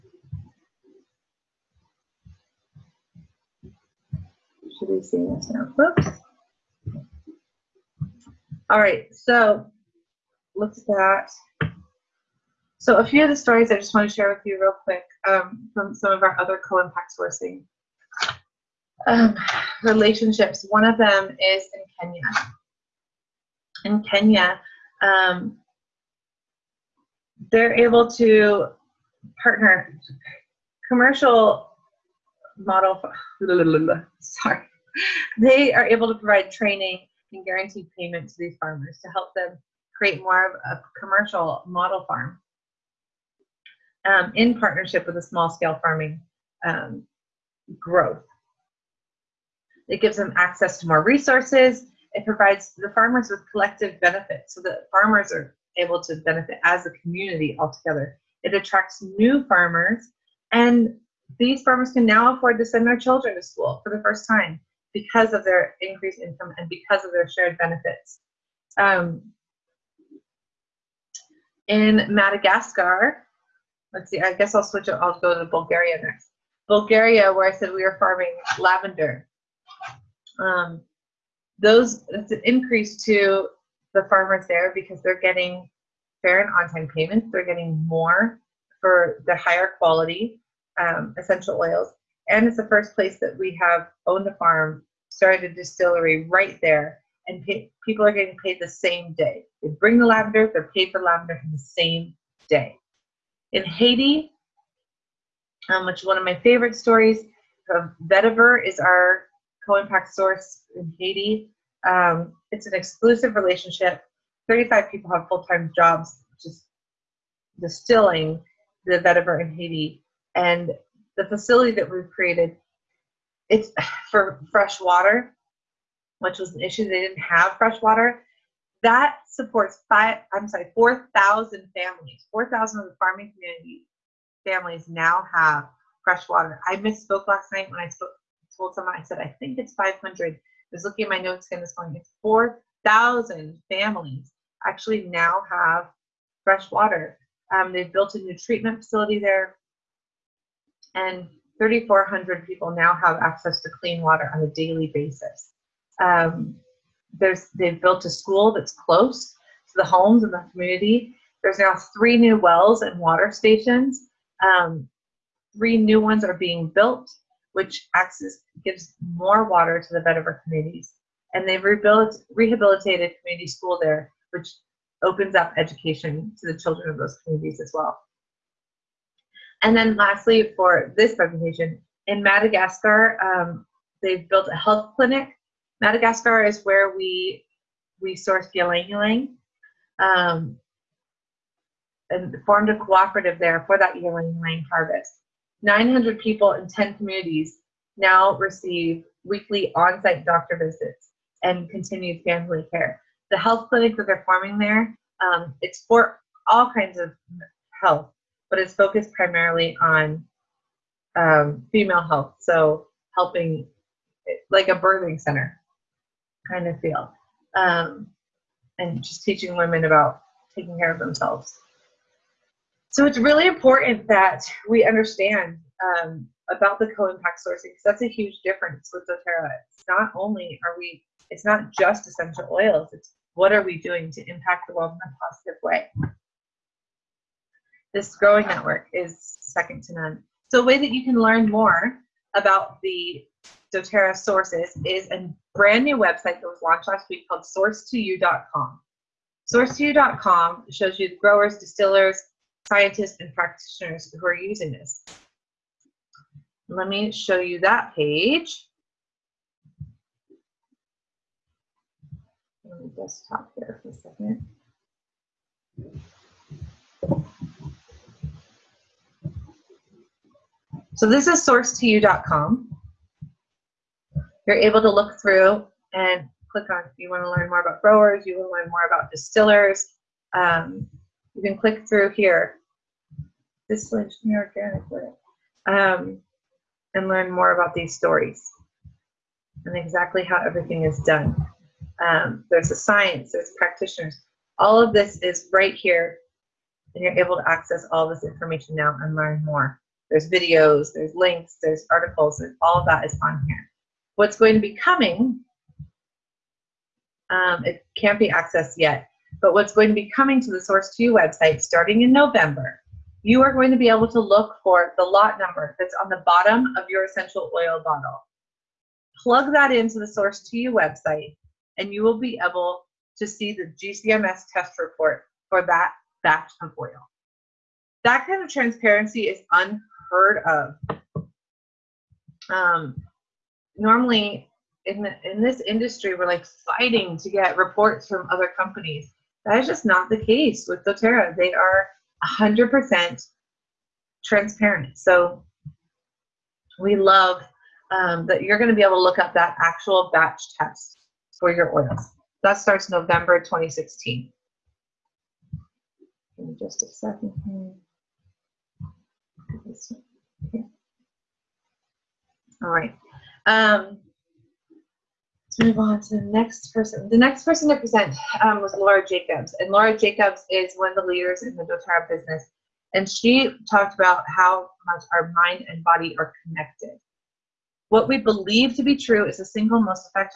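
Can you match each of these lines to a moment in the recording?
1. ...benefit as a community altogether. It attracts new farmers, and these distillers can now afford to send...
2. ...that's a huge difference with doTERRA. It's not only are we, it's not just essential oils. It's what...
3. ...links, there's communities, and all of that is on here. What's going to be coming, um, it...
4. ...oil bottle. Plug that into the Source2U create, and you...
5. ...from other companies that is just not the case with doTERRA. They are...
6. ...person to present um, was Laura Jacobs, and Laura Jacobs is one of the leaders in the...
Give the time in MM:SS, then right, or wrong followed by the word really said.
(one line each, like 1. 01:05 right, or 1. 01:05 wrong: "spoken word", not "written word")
1. 00:56 wrong: "farmers", not "distillers"
2. 03:47 right
3. 05:01 wrong: "articles", not "communities"
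4. 05:17 wrong: "website", not "create"
5. 05:38 right
6. 06:07 right.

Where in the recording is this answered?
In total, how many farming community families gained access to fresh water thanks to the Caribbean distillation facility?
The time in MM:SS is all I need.
02:22.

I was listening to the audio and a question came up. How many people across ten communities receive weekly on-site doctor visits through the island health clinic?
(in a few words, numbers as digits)
900.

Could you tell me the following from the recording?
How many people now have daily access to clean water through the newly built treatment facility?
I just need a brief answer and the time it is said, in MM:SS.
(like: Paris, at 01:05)
3,400, at 02:31.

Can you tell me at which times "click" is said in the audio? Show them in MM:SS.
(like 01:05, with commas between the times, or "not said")
04:36, 04:41.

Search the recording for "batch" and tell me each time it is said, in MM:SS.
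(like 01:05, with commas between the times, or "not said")
05:26, 05:50.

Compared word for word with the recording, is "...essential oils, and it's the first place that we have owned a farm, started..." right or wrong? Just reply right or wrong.
right.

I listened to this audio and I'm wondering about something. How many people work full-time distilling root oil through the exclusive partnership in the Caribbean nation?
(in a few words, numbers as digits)
35.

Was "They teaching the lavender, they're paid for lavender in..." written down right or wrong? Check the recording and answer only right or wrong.
wrong.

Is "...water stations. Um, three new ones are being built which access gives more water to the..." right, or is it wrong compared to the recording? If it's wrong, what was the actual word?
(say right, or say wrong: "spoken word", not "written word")
right.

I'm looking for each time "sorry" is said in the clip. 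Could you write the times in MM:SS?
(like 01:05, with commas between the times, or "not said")
00:34, 02:10.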